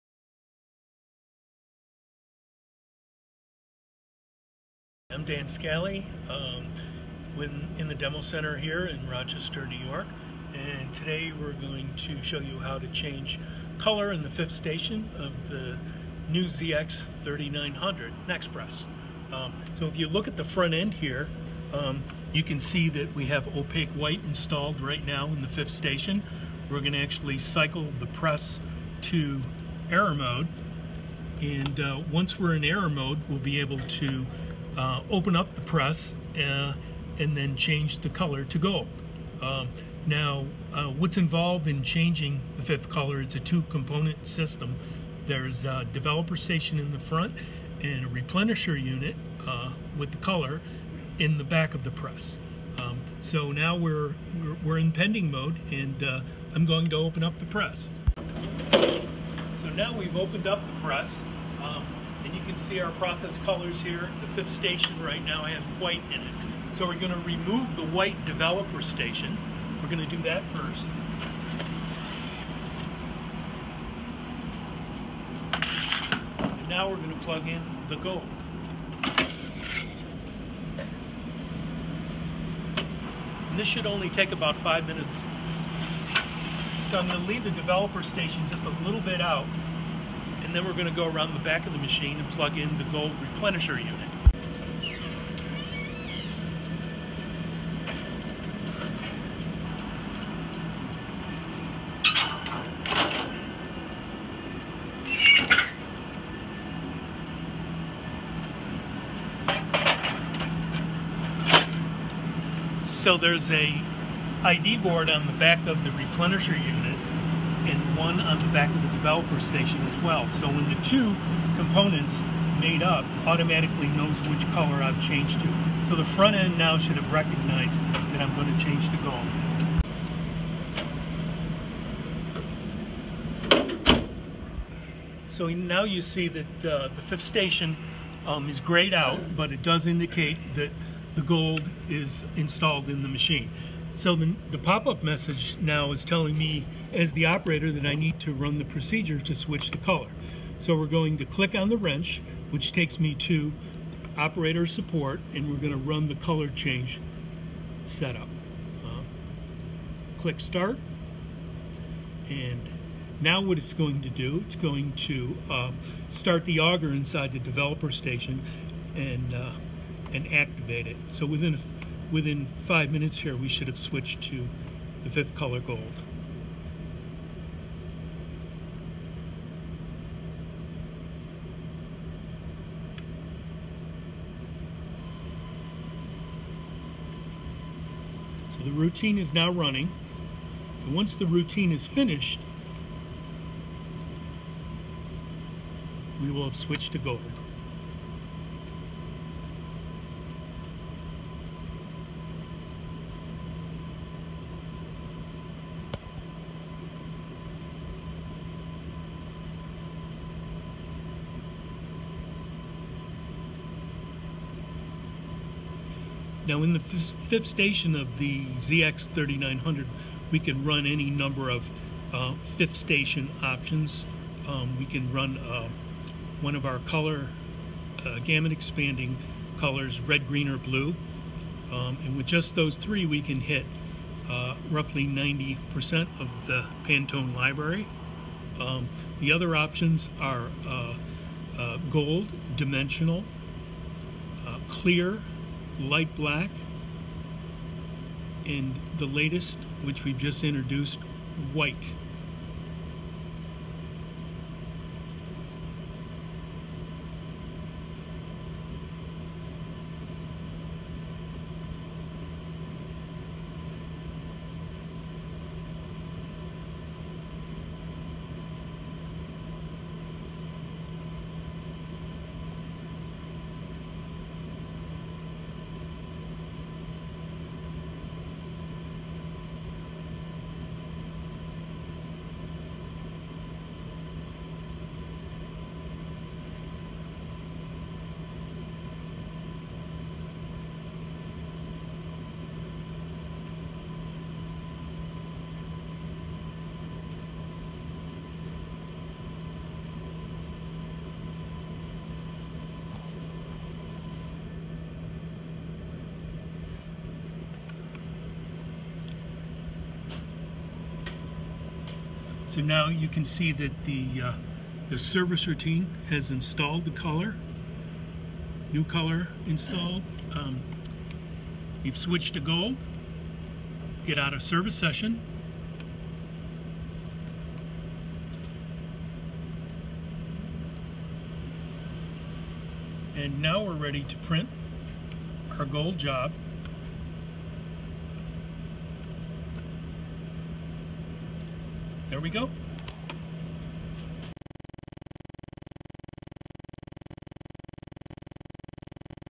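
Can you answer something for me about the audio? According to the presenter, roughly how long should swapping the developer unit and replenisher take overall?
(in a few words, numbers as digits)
5 minutes.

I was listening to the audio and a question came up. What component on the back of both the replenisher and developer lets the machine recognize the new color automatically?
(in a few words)
ID board.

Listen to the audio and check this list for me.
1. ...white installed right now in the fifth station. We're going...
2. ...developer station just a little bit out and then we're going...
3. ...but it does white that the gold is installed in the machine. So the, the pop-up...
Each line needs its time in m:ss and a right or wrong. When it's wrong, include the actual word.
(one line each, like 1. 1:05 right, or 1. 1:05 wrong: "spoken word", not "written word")
1. 0:23 right
2. 1:27 right
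3. 2:19 wrong: "indicate", not "white".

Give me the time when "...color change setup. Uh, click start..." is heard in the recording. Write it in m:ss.
2:36.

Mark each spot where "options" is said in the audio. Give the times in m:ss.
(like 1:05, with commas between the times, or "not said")
3:43, 3:59.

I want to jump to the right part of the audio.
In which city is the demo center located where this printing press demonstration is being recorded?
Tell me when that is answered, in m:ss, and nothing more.
0:09.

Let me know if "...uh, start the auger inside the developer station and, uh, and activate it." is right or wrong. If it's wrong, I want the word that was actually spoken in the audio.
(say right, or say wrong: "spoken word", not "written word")
right.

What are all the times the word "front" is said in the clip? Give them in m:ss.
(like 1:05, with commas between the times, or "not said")
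0:20, 0:46, 2:06.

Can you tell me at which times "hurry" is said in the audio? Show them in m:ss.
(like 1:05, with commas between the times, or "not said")
not said.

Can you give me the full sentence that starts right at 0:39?
Um, now, uh, what's involved in changing the fifth color, it's a two-component system.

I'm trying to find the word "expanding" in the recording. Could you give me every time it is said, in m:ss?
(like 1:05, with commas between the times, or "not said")
3:48.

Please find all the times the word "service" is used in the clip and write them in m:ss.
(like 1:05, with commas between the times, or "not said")
5:14, 5:24.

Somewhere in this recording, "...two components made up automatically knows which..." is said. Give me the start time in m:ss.
2:00.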